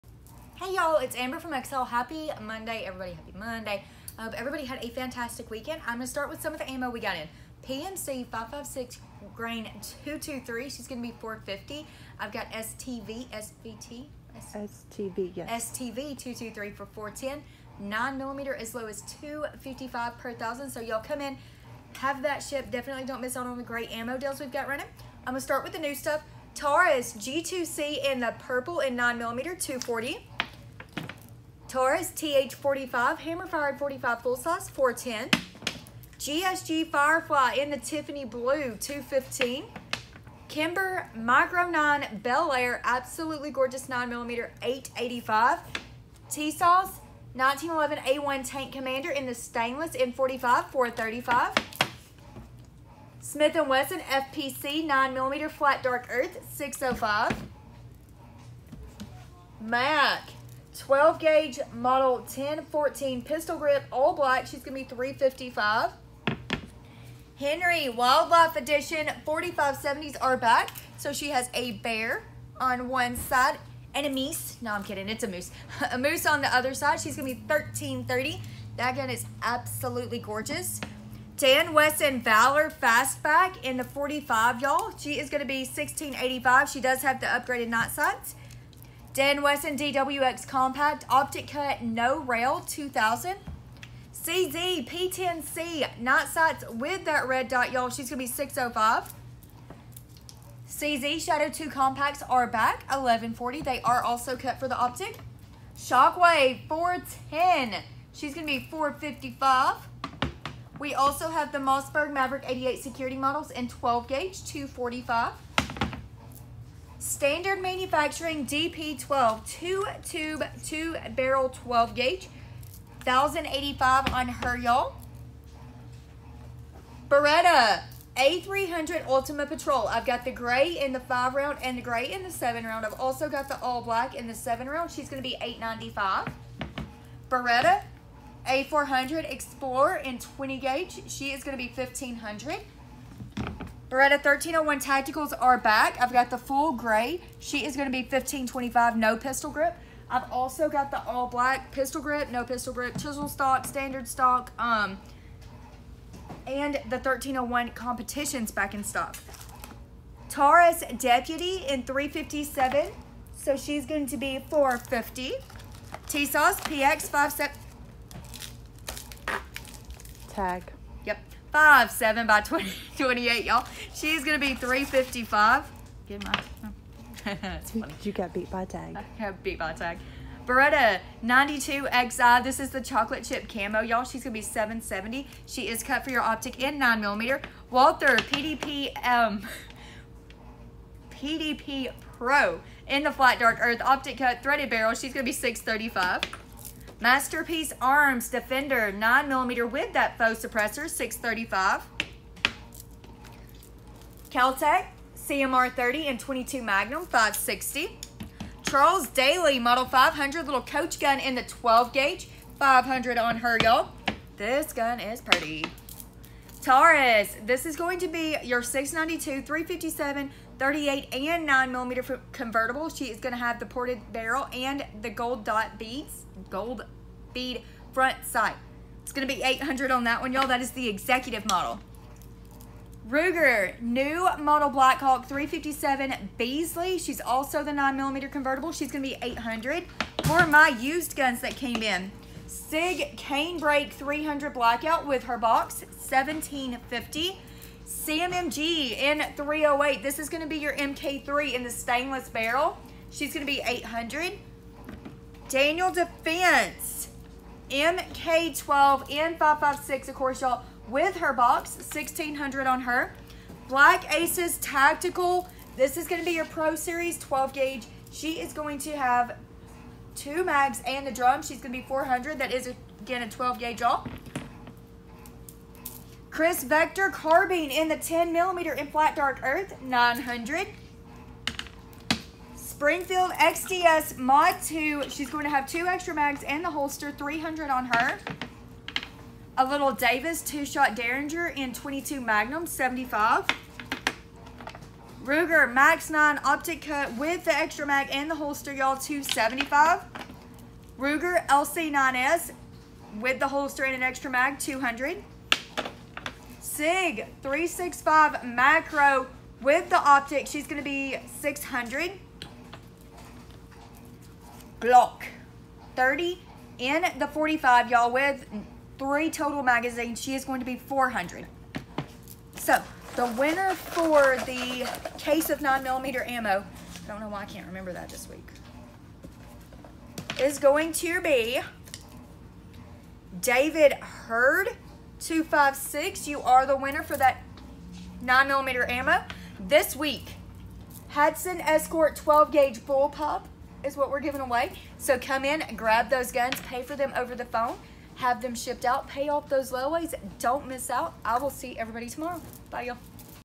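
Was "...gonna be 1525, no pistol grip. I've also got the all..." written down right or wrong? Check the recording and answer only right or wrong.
right.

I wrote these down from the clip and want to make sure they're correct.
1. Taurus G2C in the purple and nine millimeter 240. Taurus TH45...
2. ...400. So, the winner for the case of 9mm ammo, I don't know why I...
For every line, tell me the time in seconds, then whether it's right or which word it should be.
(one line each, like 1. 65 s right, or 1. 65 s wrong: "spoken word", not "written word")
1. 26 s right
2. 320 s right.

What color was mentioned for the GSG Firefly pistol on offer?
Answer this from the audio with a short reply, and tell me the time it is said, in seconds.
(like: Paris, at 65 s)
Tiffany Blue, at 37 s.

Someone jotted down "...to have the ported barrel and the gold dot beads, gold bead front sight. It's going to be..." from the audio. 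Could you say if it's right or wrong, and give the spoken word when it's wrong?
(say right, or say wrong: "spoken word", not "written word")
right.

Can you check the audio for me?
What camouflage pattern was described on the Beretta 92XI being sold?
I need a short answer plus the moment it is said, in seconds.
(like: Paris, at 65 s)
chocolate chip camo, at 182 s.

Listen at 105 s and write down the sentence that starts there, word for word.
Shockwave 410, she's going to be 455.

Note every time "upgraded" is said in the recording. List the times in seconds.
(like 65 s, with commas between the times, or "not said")
87 s.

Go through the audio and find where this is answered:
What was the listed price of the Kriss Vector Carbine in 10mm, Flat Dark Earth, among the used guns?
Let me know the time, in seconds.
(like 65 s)
279 s.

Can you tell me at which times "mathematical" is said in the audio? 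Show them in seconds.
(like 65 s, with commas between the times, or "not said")
not said.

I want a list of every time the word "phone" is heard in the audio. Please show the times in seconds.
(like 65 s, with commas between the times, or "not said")
347 s.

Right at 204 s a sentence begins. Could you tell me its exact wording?
Kel-Tec CMR 30 and 22 Magnum, 560.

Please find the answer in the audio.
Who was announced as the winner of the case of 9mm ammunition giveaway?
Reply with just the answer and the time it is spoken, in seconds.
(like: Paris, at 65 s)
David Hurd 256, at 333 s.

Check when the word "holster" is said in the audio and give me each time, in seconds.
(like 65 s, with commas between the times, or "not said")
286 s, 298 s, 303 s.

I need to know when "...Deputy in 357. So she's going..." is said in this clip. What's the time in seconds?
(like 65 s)
160 s.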